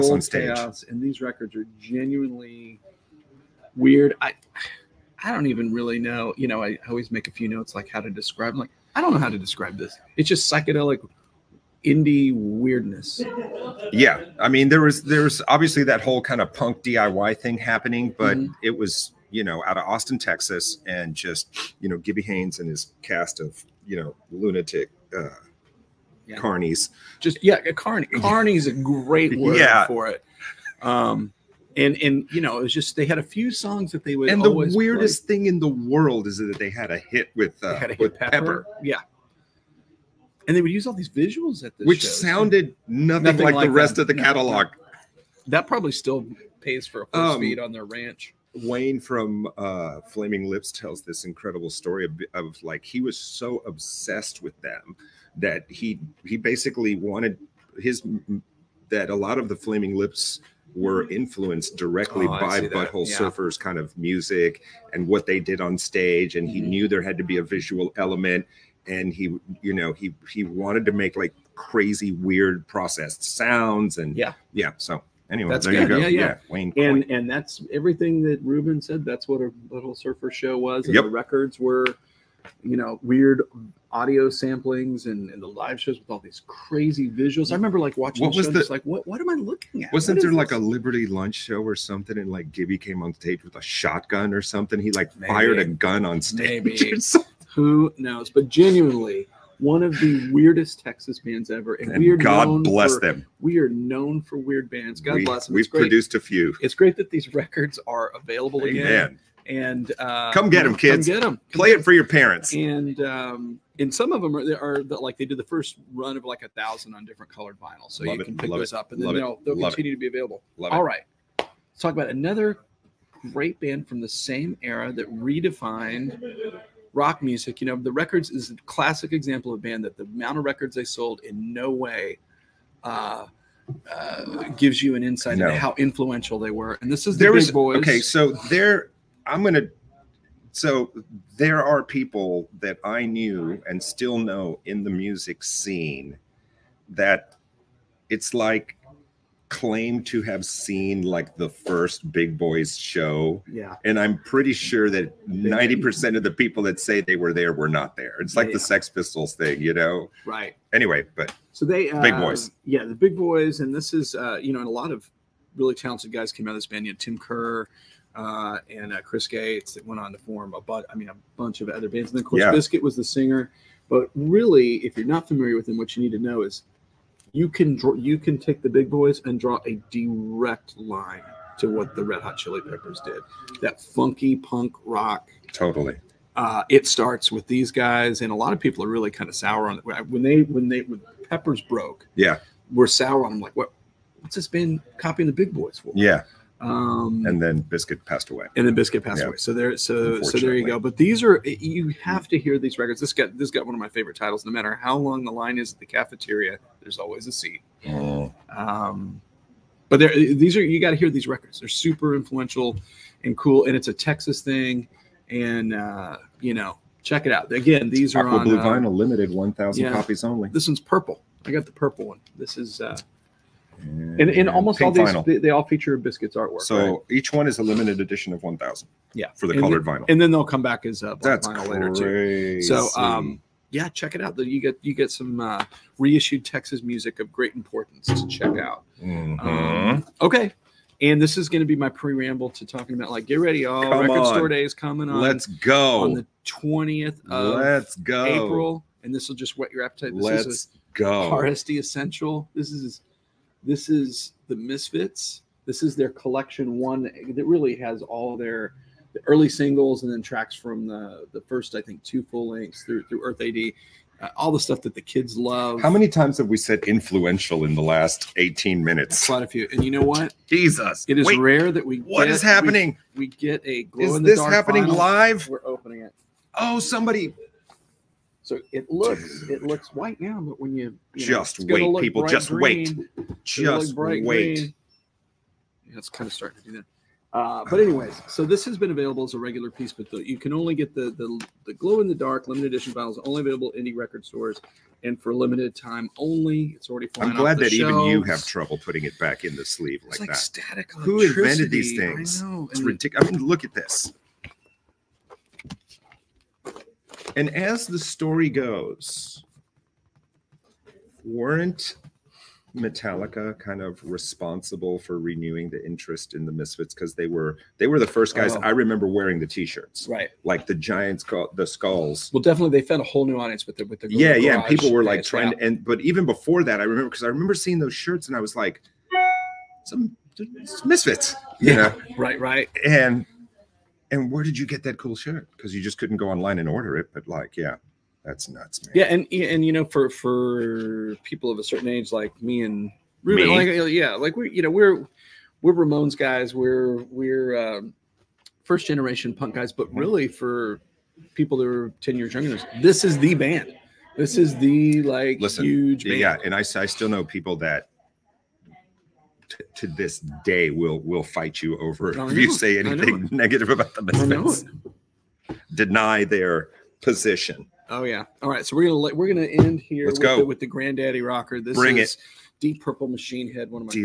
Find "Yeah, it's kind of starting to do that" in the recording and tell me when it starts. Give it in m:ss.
4:45.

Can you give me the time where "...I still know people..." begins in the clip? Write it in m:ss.
5:56.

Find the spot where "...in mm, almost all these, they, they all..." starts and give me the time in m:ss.
3:44.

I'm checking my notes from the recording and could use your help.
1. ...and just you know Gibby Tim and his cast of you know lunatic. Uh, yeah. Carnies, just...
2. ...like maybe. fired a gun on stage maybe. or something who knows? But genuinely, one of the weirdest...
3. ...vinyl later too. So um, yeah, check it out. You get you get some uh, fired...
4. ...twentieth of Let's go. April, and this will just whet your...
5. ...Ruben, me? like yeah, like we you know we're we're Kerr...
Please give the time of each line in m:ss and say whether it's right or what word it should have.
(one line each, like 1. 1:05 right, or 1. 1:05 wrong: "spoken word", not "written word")
1. 0:20 wrong: "Haynes", not "Tim"
2. 1:34 right
3. 3:51 wrong: "reissued", not "fired"
4. 4:06 right
5. 5:43 wrong: "Ramones", not "Kerr".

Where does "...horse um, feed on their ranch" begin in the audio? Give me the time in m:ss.
0:47.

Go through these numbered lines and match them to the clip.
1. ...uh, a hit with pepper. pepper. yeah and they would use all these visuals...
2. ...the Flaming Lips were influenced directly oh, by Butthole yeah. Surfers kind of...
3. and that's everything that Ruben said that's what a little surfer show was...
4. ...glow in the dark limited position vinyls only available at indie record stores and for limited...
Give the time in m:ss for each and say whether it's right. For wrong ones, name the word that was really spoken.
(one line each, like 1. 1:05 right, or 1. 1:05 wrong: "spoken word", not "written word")
1. 0:37 right
2. 0:59 right
3. 1:17 right
4. 4:51 wrong: "edition", not "position".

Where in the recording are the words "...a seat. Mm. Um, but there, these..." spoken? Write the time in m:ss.
3:27.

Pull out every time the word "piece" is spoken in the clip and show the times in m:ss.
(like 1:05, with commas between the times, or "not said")
4:49.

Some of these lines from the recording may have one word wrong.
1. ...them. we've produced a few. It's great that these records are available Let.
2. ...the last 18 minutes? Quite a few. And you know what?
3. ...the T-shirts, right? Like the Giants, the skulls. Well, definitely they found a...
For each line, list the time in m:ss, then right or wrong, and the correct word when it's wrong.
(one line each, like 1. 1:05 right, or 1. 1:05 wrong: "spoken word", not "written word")
1. 1:45 wrong: "Amen", not "Let"
2. 4:27 right
3. 5:19 right.